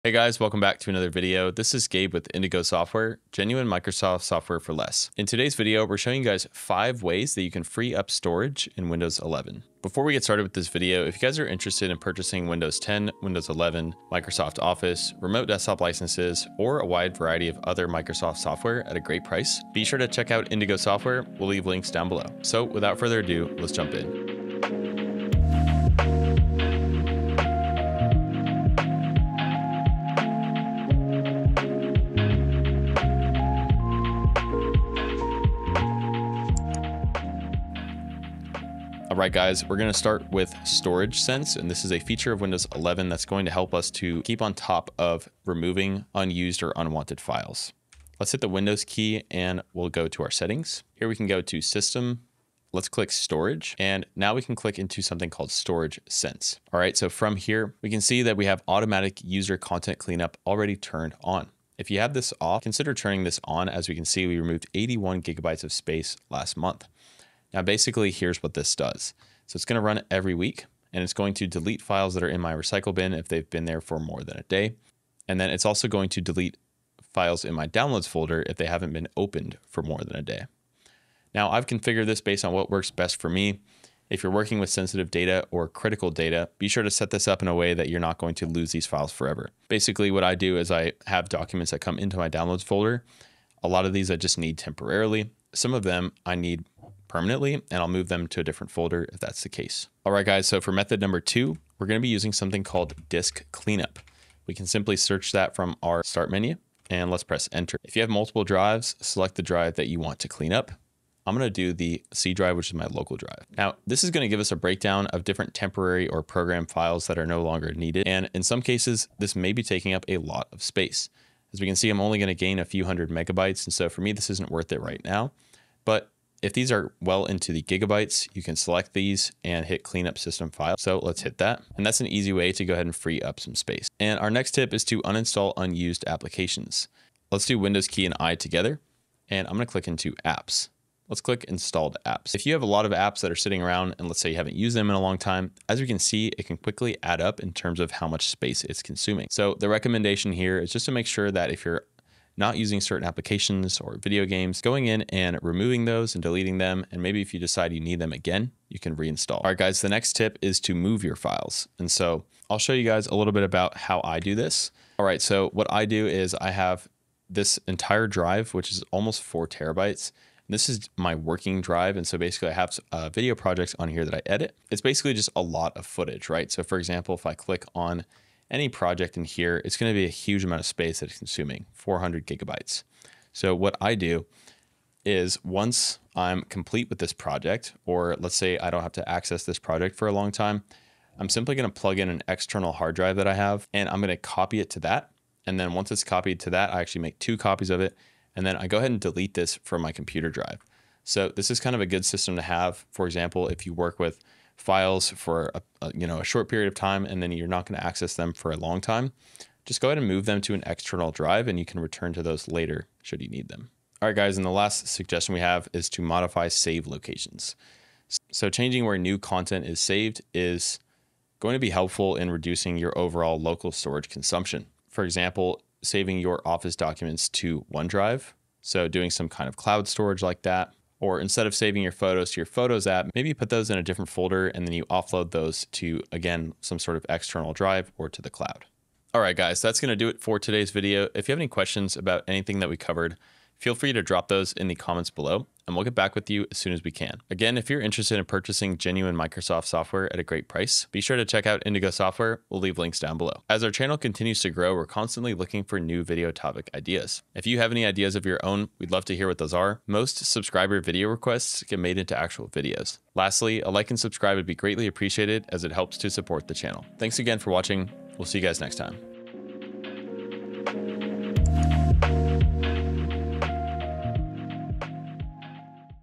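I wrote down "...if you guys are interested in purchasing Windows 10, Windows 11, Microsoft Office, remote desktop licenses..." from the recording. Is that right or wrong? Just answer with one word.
right.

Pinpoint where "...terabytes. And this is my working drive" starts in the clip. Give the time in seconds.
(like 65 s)
169 s.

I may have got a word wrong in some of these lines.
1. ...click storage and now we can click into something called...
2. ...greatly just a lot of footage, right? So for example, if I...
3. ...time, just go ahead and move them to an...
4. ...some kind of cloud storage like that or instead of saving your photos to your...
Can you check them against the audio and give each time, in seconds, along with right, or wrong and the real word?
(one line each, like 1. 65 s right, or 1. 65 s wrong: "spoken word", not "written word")
1. 52 s right
2. 174 s wrong: "basically", not "greatly"
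3. 208 s right
4. 229 s right.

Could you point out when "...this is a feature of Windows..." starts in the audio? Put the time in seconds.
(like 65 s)
41 s.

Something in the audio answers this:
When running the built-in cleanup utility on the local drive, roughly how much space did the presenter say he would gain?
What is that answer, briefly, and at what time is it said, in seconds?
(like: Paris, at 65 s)
A few hundred megabytes, at 122 s.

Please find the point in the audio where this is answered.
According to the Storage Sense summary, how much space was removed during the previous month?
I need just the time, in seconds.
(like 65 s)
64 s.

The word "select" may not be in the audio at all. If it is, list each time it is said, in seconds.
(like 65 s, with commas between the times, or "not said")
109 s, 128 s.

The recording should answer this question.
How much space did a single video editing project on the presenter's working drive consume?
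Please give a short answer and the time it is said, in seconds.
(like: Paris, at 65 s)
400 gigabytes, at 181 s.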